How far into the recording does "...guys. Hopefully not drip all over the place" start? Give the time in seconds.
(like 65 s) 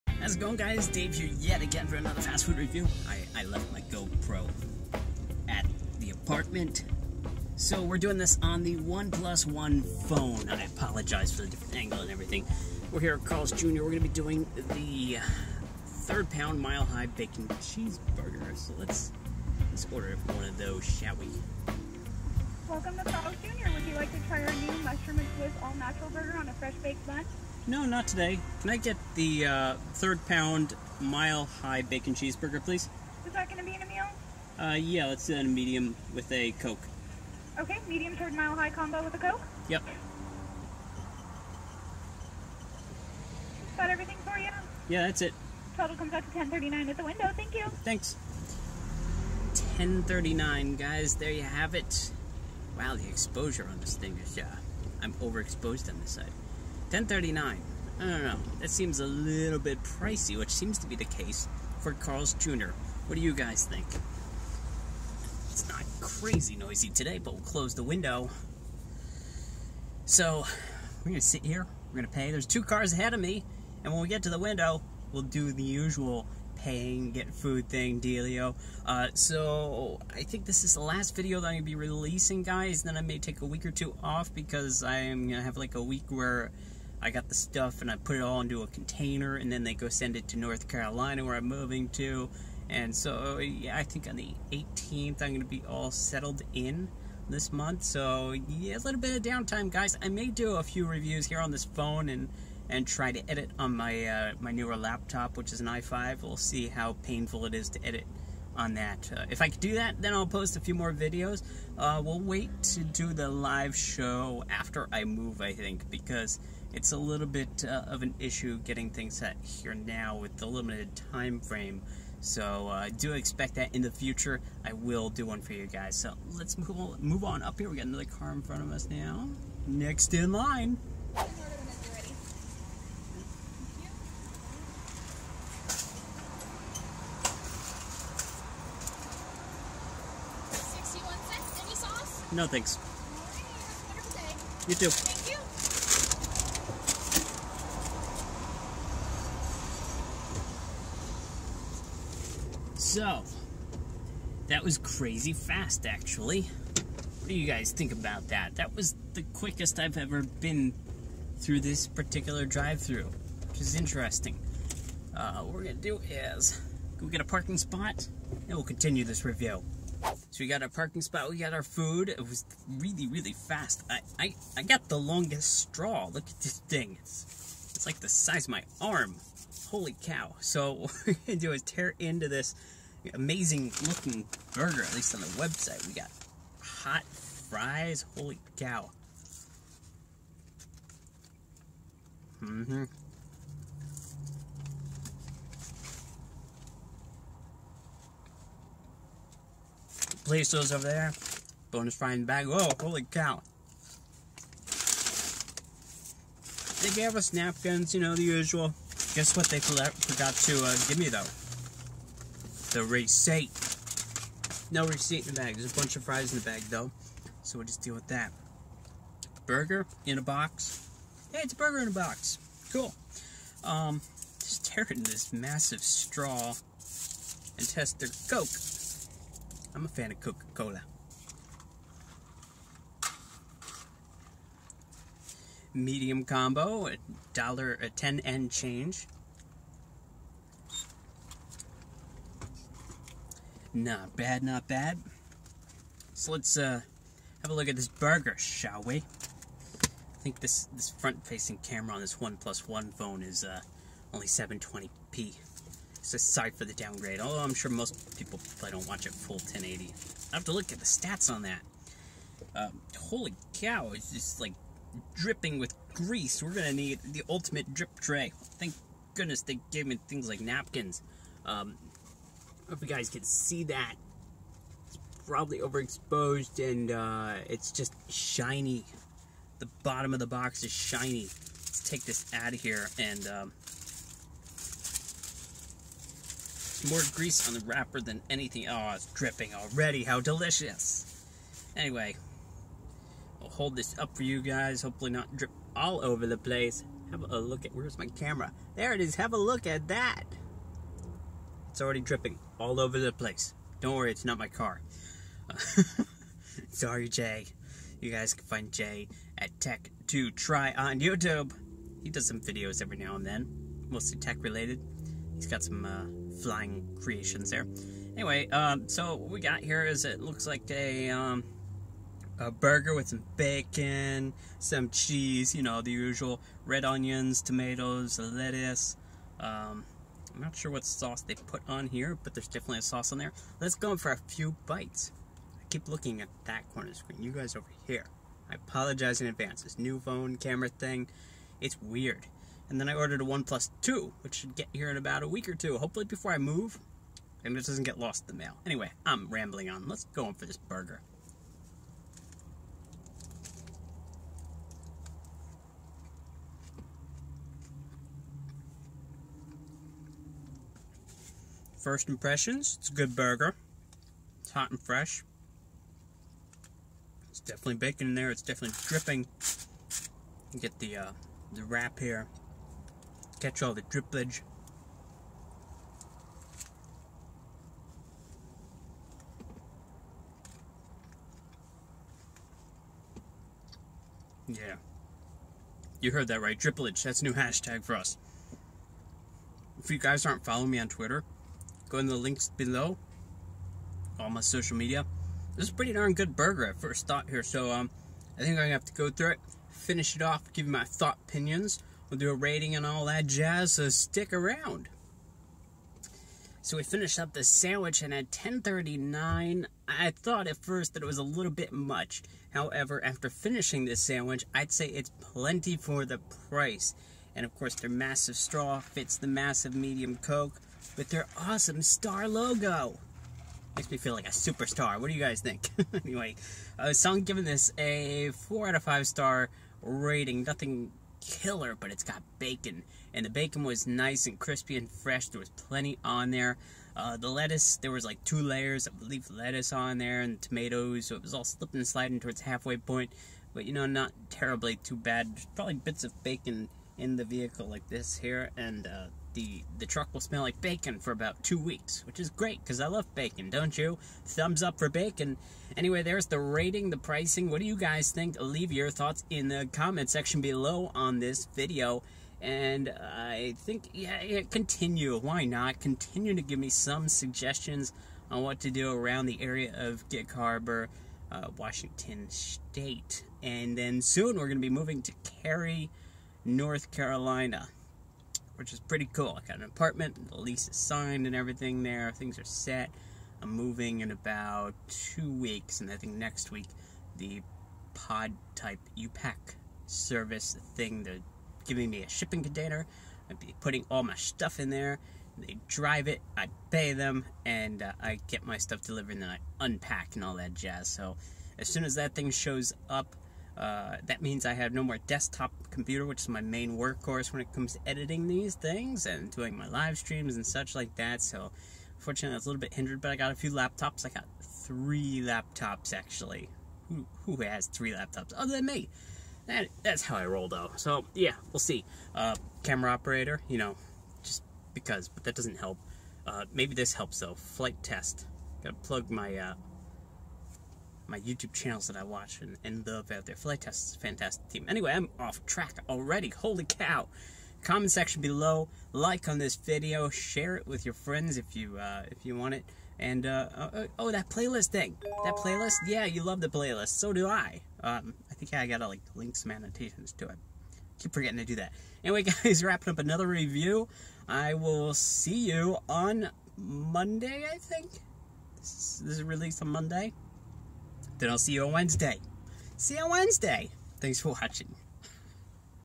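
294 s.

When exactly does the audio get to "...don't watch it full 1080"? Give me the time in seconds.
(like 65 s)
258 s.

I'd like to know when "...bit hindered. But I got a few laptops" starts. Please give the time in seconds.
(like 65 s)
512 s.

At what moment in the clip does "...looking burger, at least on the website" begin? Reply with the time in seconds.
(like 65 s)
183 s.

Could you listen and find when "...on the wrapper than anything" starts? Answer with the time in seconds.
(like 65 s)
287 s.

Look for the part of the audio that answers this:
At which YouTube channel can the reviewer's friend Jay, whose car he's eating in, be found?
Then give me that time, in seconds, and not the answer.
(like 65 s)
309 s.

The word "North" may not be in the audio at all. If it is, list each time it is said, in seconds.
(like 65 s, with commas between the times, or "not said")
90 s, 476 s.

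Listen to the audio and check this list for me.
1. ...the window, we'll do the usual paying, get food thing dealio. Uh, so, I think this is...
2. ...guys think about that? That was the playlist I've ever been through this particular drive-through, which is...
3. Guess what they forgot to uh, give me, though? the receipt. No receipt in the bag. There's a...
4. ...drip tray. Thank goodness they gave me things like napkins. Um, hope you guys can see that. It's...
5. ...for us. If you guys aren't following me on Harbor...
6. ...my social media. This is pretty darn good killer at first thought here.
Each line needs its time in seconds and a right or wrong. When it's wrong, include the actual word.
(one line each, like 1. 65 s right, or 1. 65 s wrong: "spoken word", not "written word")
1. 74 s right
2. 157 s wrong: "quickest", not "playlist"
3. 209 s right
4. 267 s right
5. 387 s wrong: "Twitter", not "Harbor"
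6. 394 s wrong: "burger", not "killer".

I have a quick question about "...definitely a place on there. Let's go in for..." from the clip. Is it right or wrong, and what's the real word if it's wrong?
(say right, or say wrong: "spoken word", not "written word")
wrong: "sauce", not "place".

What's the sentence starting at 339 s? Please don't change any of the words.
This new phone camera thing, it's weird.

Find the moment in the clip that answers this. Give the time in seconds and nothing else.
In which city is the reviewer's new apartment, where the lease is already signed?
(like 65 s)
475 s.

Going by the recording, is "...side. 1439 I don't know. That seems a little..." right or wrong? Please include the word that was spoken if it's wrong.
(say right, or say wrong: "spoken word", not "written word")
wrong: "1039", not "1439".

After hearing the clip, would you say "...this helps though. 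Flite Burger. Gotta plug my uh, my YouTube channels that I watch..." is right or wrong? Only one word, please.
wrong.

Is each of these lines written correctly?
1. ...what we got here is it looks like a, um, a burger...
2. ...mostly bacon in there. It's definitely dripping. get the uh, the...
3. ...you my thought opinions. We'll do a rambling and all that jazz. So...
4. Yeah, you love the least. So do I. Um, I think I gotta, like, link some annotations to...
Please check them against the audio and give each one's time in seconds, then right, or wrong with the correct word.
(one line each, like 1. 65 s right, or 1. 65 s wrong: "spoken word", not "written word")
1. 319 s right
2. 367 s wrong: "definitely", not "mostly"
3. 400 s wrong: "rating", not "rambling"
4. 545 s wrong: "playlist", not "least".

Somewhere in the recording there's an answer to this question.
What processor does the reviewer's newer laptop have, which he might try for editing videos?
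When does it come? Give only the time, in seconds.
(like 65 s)
105 s.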